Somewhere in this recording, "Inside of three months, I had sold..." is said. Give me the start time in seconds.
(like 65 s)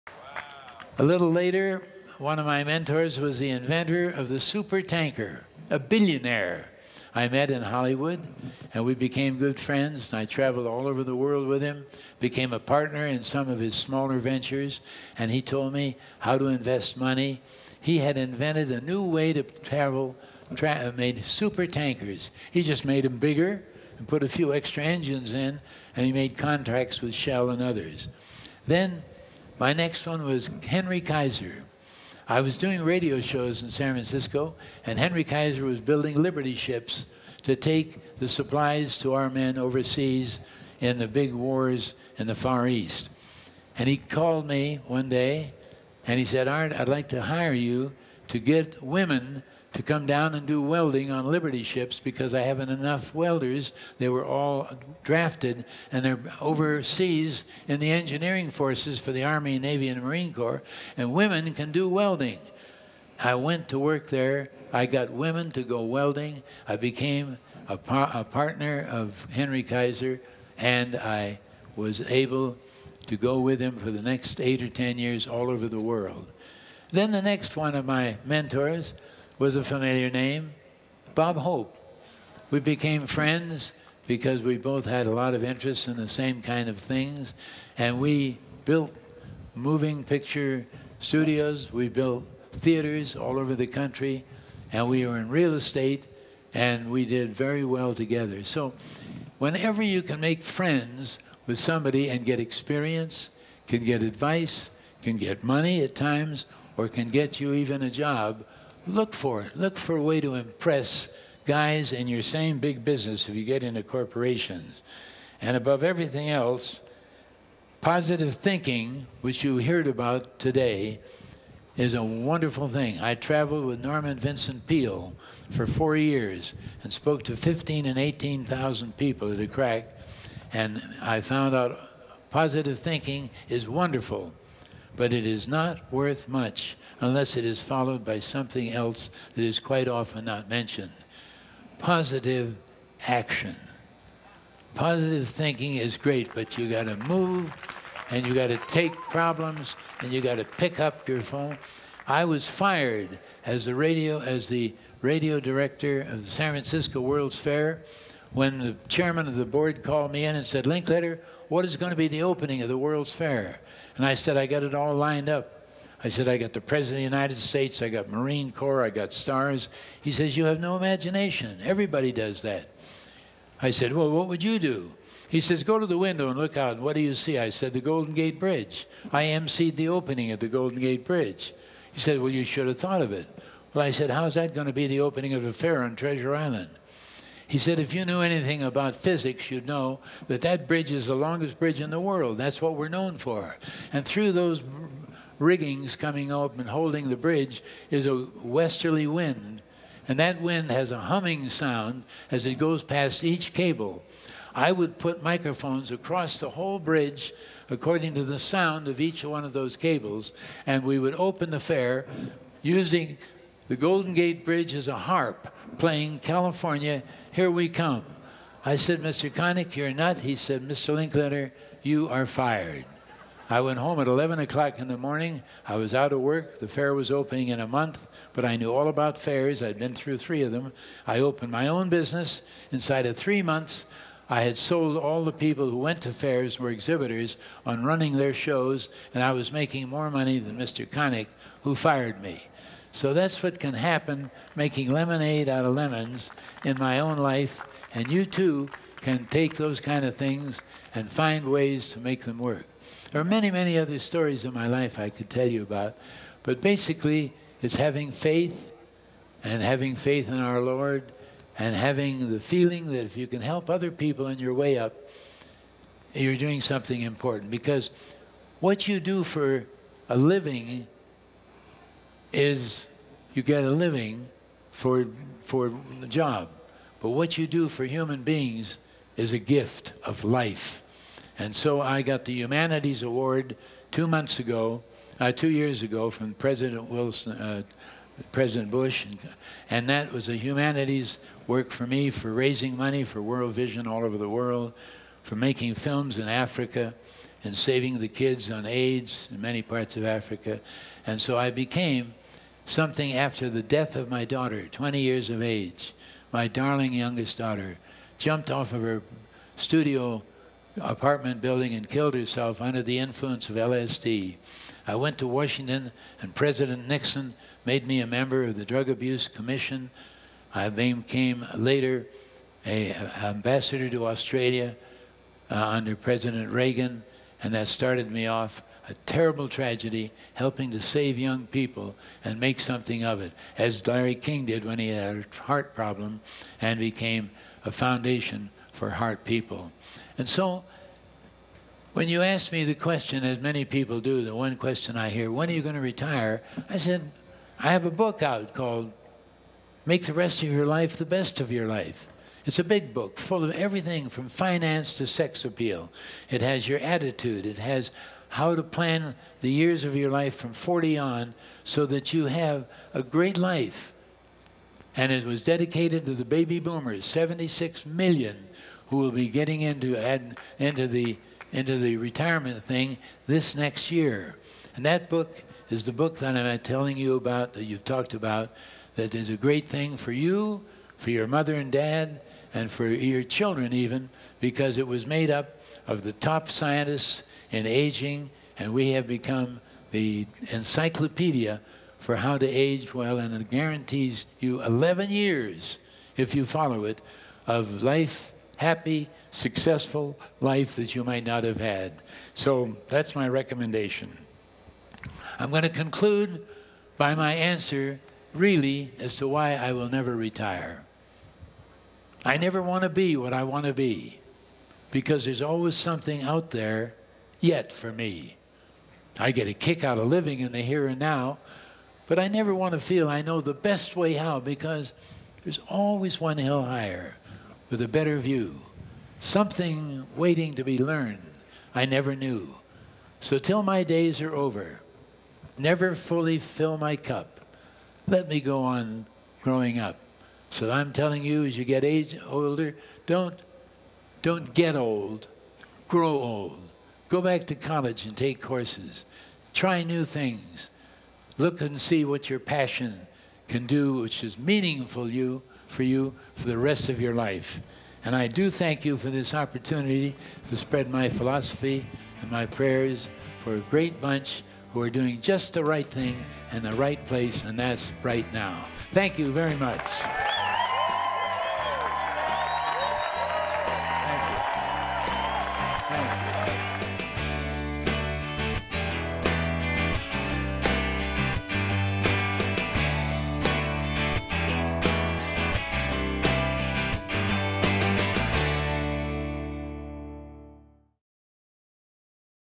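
232 s.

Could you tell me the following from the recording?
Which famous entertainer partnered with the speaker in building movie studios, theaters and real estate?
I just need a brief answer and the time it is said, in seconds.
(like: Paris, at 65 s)
Bob Hope, at 81 s.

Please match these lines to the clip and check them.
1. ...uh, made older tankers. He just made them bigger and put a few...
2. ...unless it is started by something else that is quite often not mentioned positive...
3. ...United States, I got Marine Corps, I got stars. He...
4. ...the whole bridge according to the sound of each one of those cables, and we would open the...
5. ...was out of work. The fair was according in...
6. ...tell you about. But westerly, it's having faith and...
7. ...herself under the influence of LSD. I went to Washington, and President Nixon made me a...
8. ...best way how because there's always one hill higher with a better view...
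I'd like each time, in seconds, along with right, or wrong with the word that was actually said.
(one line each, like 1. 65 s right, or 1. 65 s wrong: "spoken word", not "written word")
1. 20 s wrong: "super", not "older"
2. 137 s wrong: "followed", not "started"
3. 167 s right
4. 206 s right
5. 225 s wrong: "opening", not "according"
6. 255 s wrong: "basically", not "westerly"
7. 312 s right
8. 423 s right.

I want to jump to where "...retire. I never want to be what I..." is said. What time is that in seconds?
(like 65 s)
410 s.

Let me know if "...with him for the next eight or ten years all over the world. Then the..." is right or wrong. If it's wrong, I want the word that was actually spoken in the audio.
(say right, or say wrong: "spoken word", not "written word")
right.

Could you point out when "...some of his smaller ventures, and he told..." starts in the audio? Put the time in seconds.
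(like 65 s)
13 s.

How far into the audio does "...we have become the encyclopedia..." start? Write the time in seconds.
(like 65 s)
388 s.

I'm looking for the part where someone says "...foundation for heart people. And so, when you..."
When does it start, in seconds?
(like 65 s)
337 s.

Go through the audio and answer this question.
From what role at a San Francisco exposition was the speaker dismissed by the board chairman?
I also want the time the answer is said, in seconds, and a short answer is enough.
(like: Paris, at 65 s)
radio director, at 155 s.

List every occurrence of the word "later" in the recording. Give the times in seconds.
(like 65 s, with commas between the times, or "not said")
1 s, 321 s.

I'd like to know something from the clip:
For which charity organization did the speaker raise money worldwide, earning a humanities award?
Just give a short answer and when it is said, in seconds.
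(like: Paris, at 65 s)
World Vision, at 293 s.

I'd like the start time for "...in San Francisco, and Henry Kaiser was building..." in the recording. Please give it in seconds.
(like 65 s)
33 s.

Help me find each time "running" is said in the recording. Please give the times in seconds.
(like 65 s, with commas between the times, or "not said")
237 s.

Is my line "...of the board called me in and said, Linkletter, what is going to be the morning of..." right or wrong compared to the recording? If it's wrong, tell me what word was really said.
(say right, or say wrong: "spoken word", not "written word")
wrong: "opening", not "morning".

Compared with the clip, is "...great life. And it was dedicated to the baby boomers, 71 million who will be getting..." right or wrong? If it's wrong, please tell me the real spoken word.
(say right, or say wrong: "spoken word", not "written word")
wrong: "76", not "71".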